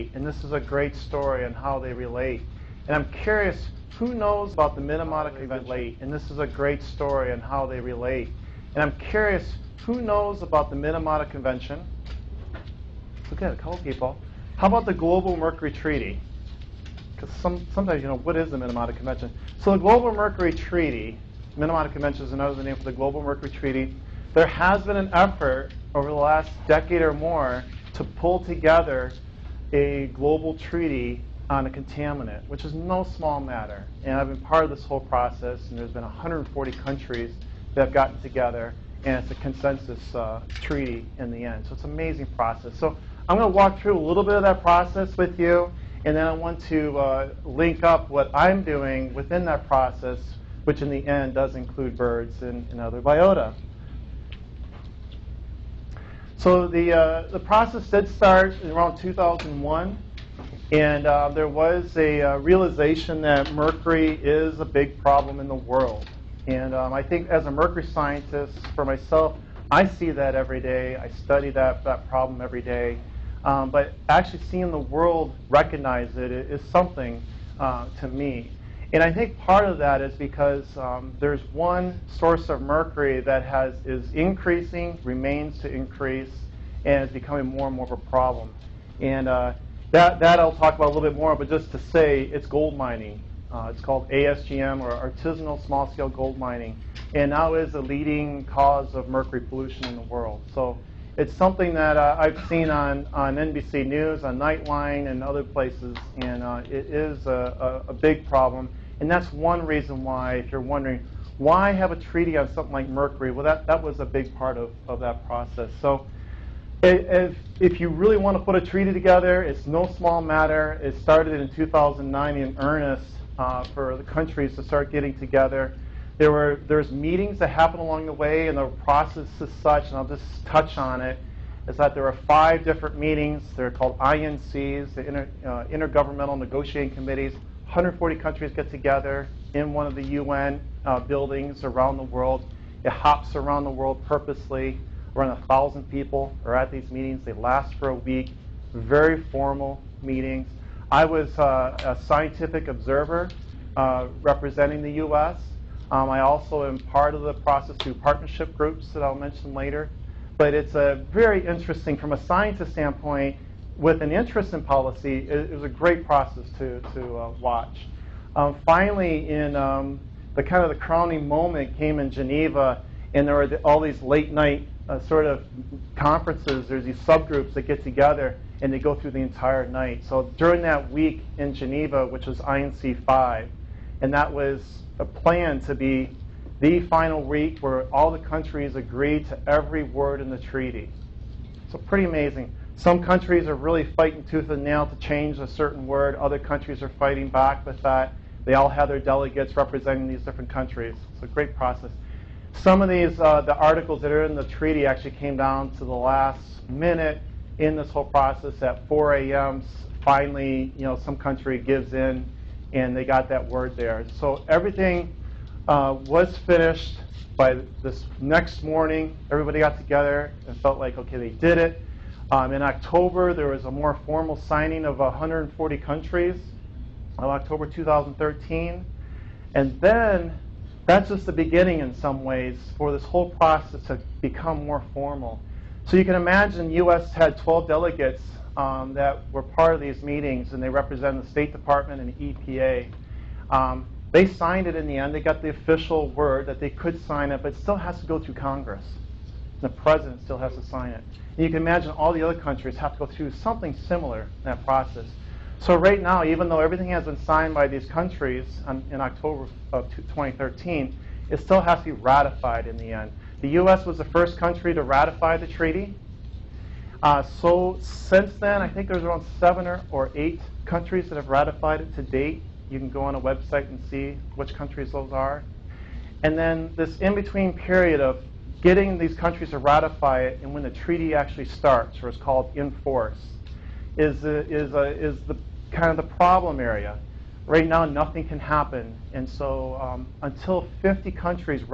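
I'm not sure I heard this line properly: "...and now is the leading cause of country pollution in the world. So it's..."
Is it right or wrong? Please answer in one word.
wrong.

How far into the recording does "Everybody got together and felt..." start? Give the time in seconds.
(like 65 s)
219 s.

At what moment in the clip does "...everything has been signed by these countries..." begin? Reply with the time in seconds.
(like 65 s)
256 s.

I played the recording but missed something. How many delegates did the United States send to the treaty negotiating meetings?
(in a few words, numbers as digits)
12.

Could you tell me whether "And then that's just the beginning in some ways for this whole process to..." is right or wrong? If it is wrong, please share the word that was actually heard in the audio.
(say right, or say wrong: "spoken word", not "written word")
right.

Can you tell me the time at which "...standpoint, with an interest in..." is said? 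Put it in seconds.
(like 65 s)
162 s.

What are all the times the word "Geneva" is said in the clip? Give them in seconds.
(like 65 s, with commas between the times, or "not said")
172 s, 181 s.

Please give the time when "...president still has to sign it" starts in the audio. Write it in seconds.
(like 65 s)
249 s.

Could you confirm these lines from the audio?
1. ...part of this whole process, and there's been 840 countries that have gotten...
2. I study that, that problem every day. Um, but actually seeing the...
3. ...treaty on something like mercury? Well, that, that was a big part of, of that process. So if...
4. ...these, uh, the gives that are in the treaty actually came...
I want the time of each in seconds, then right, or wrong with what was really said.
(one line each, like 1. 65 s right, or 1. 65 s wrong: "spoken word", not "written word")
1. 34 s wrong: "140", not "840"
2. 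70 s right
3. 111 s right
4. 202 s wrong: "articles", not "gives".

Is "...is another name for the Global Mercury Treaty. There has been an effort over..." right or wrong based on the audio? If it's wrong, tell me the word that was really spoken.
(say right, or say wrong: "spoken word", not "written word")
right.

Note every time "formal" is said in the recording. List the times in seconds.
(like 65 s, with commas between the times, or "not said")
149 s, 224 s, 234 s.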